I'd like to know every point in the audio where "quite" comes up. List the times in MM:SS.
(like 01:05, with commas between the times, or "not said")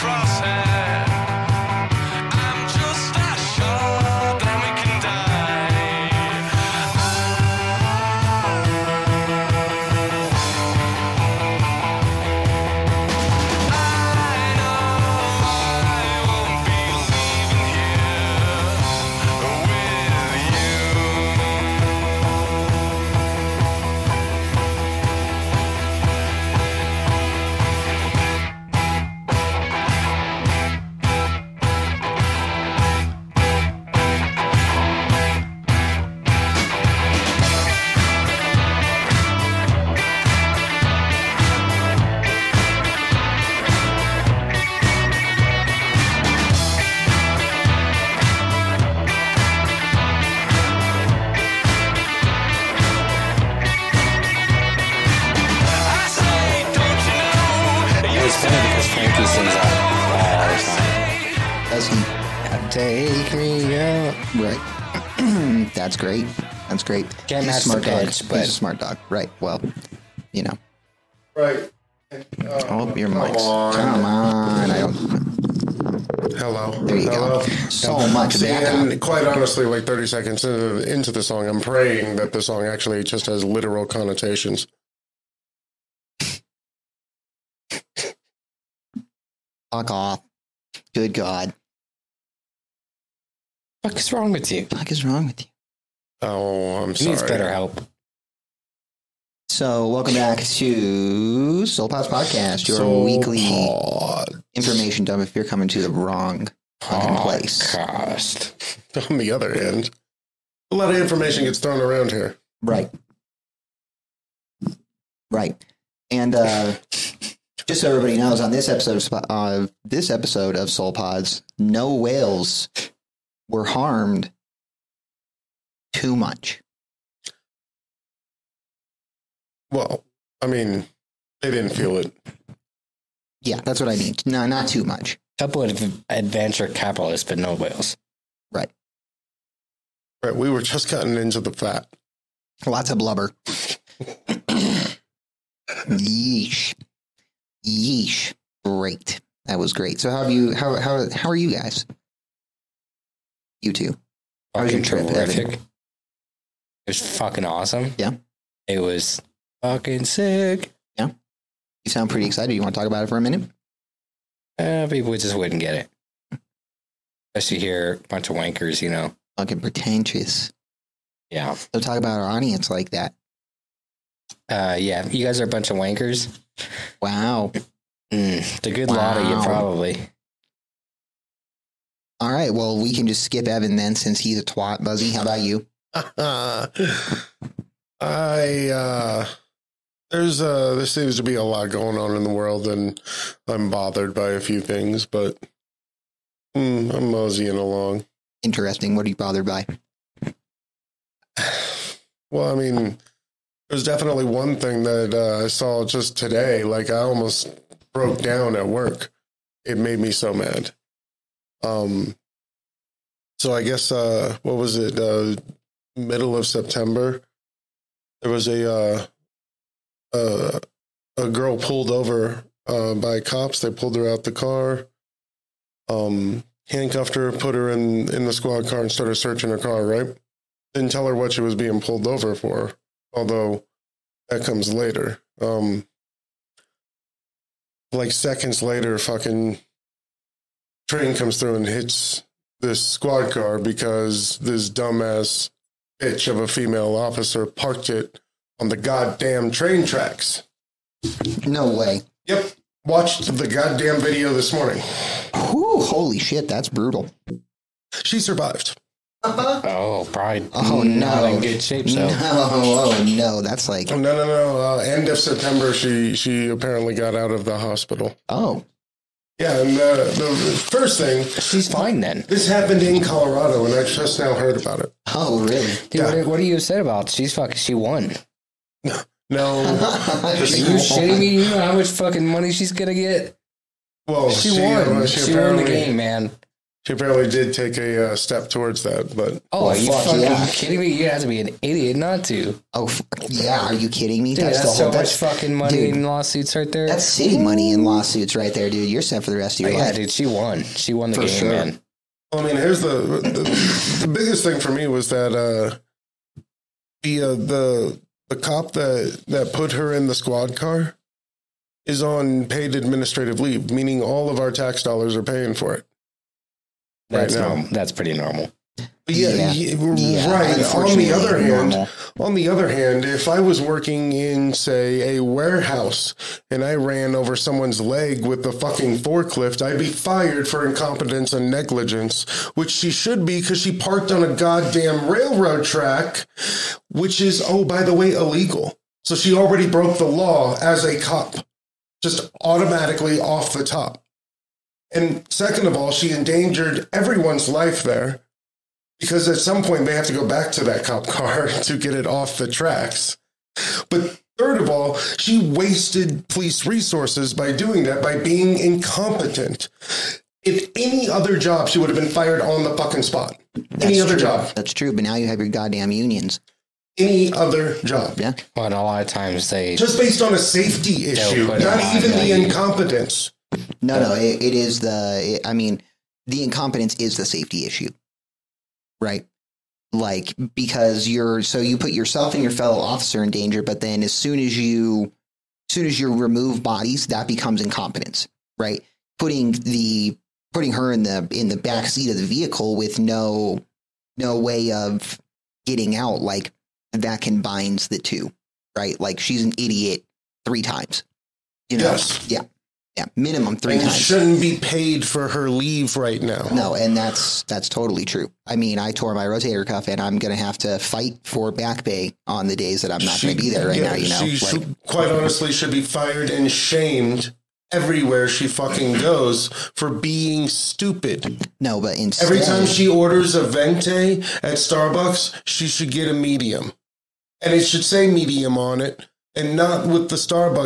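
01:18, 06:54.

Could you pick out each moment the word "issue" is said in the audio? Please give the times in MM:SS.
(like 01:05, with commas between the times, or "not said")
06:11, 06:17.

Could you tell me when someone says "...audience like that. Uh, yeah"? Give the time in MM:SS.
02:52.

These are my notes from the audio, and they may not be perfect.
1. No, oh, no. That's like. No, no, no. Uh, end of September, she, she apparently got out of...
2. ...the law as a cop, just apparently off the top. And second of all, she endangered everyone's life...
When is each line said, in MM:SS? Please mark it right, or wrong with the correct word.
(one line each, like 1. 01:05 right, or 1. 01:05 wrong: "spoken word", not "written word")
1. 04:22 right
2. 05:39 wrong: "automatically", not "apparently".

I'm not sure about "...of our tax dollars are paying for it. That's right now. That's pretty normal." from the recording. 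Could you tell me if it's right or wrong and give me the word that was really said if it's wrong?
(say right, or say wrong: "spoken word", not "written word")
right.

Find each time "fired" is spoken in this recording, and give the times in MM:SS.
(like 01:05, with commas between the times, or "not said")
05:29, 06:02, 06:55.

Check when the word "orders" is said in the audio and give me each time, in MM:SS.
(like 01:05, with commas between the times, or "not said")
07:02.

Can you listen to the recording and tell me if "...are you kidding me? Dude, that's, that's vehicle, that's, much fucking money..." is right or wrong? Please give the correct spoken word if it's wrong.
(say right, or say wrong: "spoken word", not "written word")
wrong: "whole", not "vehicle".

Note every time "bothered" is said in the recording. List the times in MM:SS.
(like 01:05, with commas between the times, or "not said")
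03:13, 03:19.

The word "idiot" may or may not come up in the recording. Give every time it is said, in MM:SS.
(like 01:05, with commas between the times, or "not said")
04:51, 06:39.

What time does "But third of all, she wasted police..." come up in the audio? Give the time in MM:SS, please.
05:53.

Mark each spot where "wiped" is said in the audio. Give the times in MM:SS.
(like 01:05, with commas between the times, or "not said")
not said.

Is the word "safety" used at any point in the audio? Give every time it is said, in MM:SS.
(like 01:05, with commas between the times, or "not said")
06:10, 06:17.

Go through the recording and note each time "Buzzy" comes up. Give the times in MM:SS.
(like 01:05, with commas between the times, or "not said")
03:04.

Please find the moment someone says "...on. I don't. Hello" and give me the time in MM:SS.
01:14.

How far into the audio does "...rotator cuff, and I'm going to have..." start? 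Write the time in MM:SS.
06:49.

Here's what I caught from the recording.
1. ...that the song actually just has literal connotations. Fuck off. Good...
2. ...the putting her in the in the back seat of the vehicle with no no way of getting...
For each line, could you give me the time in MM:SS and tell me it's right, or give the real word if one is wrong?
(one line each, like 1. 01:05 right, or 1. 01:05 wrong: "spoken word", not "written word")
1. 01:22 right
2. 06:29 right.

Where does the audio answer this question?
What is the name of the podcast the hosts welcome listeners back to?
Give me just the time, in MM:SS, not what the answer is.
01:41.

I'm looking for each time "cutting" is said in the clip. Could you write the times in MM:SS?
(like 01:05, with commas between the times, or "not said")
02:20.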